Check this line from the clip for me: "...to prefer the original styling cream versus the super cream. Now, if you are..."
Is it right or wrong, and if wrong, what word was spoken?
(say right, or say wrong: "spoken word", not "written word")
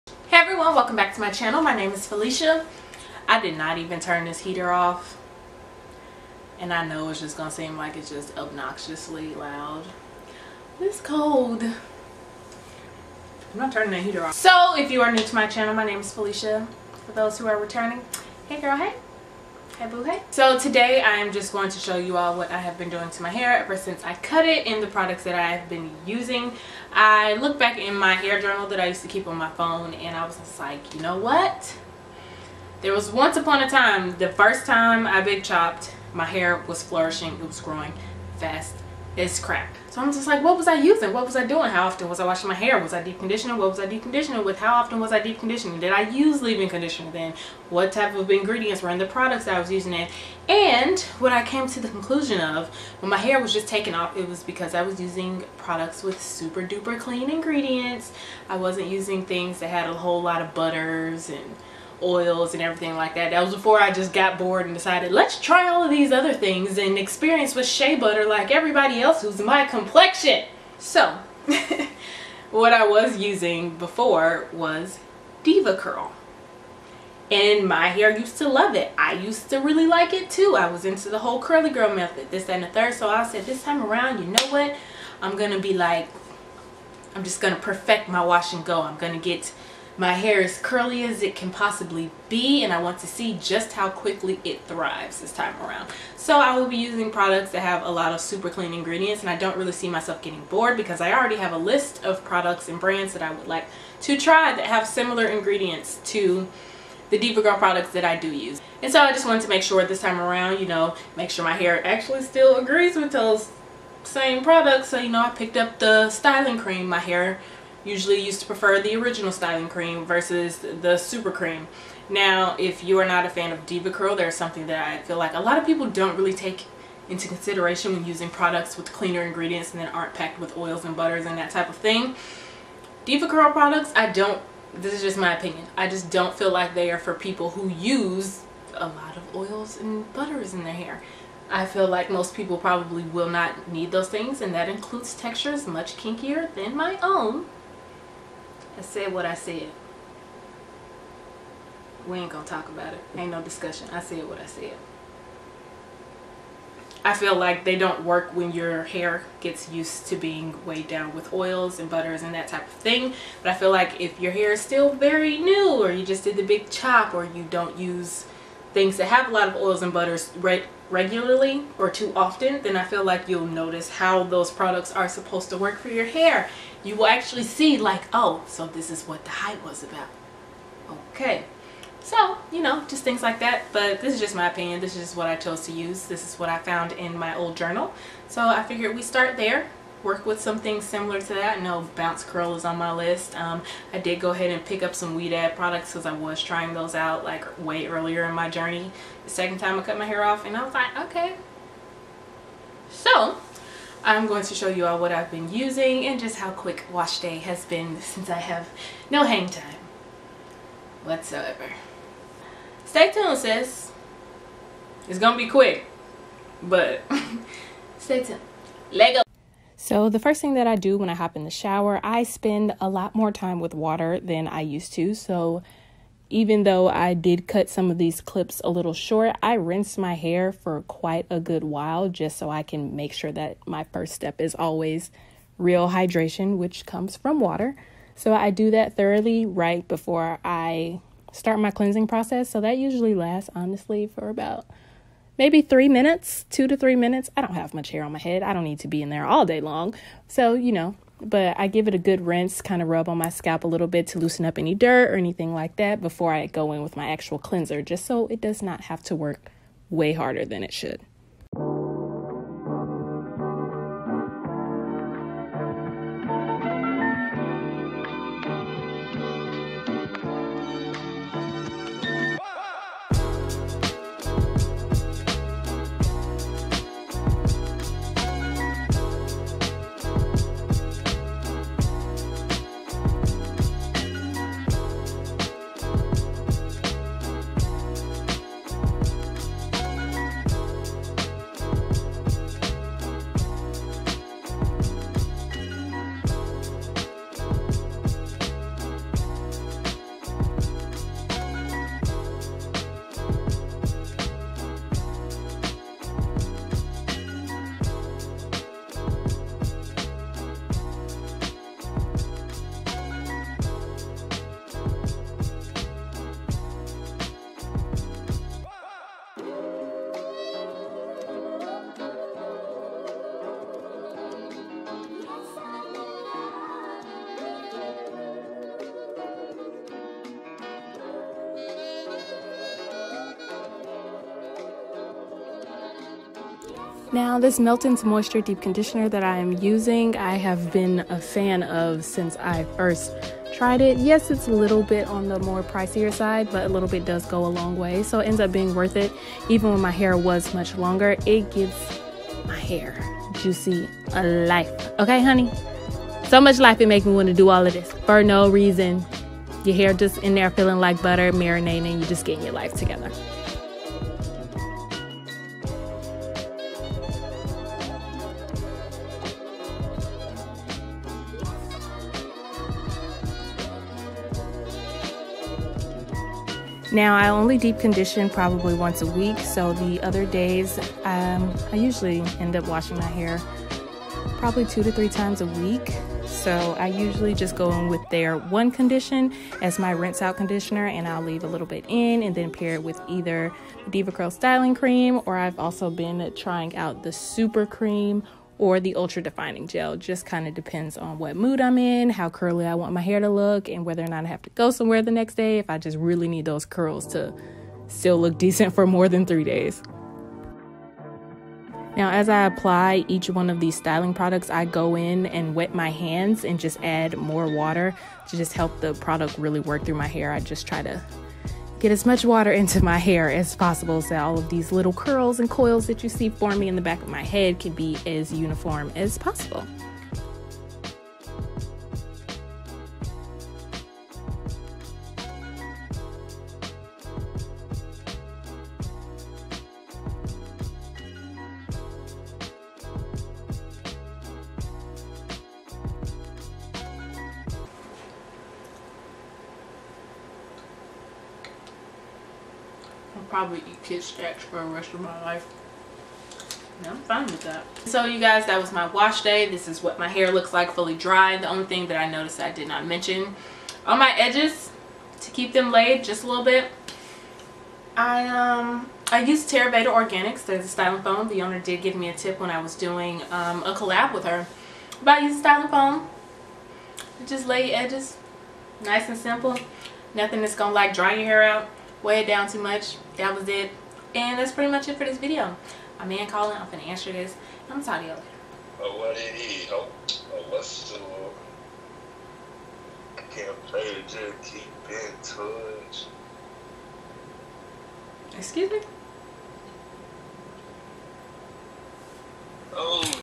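right.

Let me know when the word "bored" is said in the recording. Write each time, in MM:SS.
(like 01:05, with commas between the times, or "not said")
01:04, 01:40.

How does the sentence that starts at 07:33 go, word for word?
probably eat kid snacks for the rest of my life.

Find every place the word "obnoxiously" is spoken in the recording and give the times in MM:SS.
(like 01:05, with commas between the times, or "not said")
00:08.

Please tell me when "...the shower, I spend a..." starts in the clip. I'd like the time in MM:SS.
03:41.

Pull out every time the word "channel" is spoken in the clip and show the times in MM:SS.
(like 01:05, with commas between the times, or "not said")
00:01, 00:15.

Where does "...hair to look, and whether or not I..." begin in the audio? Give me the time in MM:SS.
06:43.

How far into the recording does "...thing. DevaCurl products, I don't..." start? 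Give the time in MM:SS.
02:11.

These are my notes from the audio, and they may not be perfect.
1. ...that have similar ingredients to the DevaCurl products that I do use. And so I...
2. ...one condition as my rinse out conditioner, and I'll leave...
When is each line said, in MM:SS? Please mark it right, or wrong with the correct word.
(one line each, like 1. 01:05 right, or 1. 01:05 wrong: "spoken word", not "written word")
1. 01:44 right
2. 06:28 right.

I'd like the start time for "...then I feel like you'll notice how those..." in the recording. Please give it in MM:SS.
02:52.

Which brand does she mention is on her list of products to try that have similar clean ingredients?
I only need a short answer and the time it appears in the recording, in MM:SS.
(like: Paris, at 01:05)
Bounce Curl, at 03:11.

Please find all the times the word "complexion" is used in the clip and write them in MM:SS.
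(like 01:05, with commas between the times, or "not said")
01:09.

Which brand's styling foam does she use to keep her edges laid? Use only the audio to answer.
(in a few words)
Terabeta Organics.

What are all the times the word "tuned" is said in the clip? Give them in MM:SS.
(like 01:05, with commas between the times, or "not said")
03:33, 03:38.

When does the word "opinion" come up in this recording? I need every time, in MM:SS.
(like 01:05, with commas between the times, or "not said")
02:15, 03:04.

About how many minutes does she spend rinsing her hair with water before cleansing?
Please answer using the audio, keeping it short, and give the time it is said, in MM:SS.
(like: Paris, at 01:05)
2 to 3 minutes, at 04:06.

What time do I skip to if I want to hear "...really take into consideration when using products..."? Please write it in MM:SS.
02:06.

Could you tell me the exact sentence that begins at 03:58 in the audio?
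So I do that thoroughly right before I start my cleansing process.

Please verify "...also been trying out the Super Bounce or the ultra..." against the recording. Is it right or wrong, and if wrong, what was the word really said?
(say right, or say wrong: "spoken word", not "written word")
wrong: "Cream", not "Bounce".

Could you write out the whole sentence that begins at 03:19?
The second time I cut my hair off and I was like, okay.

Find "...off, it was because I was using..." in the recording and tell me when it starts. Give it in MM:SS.
00:53.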